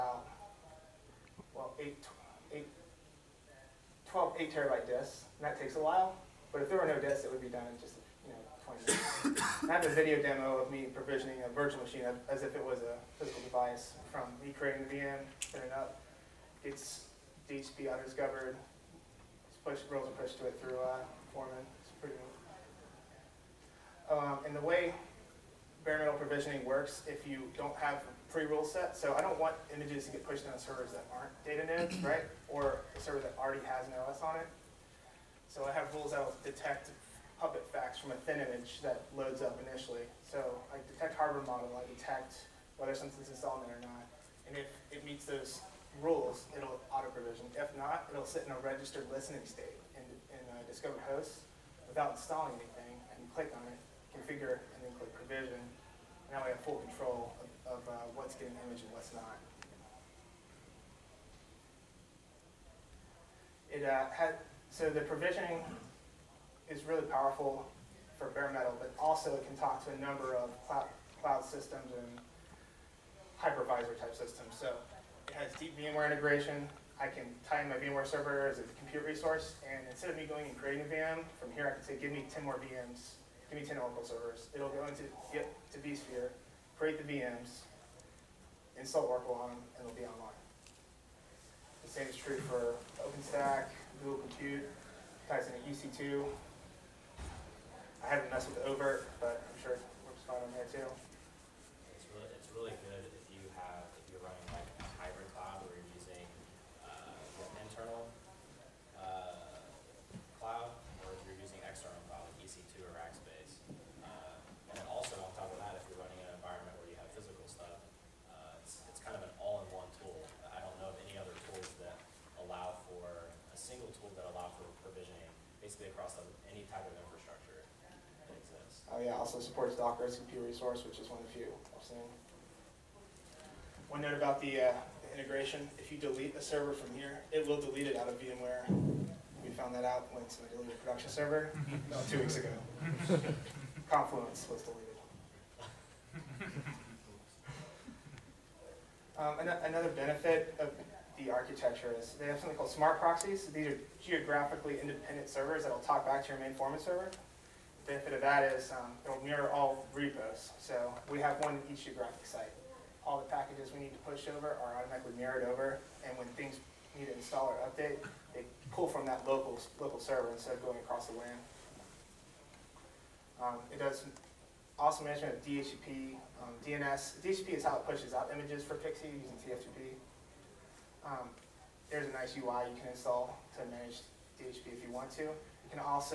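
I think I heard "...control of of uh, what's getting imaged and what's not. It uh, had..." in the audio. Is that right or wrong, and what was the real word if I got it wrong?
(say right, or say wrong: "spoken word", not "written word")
right.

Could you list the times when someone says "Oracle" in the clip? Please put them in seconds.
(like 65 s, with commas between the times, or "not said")
83 s, 89 s.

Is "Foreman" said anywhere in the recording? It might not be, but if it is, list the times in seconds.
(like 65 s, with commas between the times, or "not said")
21 s, 156 s.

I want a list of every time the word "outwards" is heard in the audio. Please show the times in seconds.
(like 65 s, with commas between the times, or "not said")
not said.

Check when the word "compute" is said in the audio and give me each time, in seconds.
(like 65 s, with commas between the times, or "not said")
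78 s, 94 s.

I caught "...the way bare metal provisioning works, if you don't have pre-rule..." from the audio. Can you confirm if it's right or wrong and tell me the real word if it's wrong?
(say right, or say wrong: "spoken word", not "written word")
right.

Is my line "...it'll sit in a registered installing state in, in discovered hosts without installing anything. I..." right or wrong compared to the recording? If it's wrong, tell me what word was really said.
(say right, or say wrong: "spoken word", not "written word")
wrong: "listening", not "installing".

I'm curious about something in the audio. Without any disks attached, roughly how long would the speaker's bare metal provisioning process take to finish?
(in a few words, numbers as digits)
20 minutes.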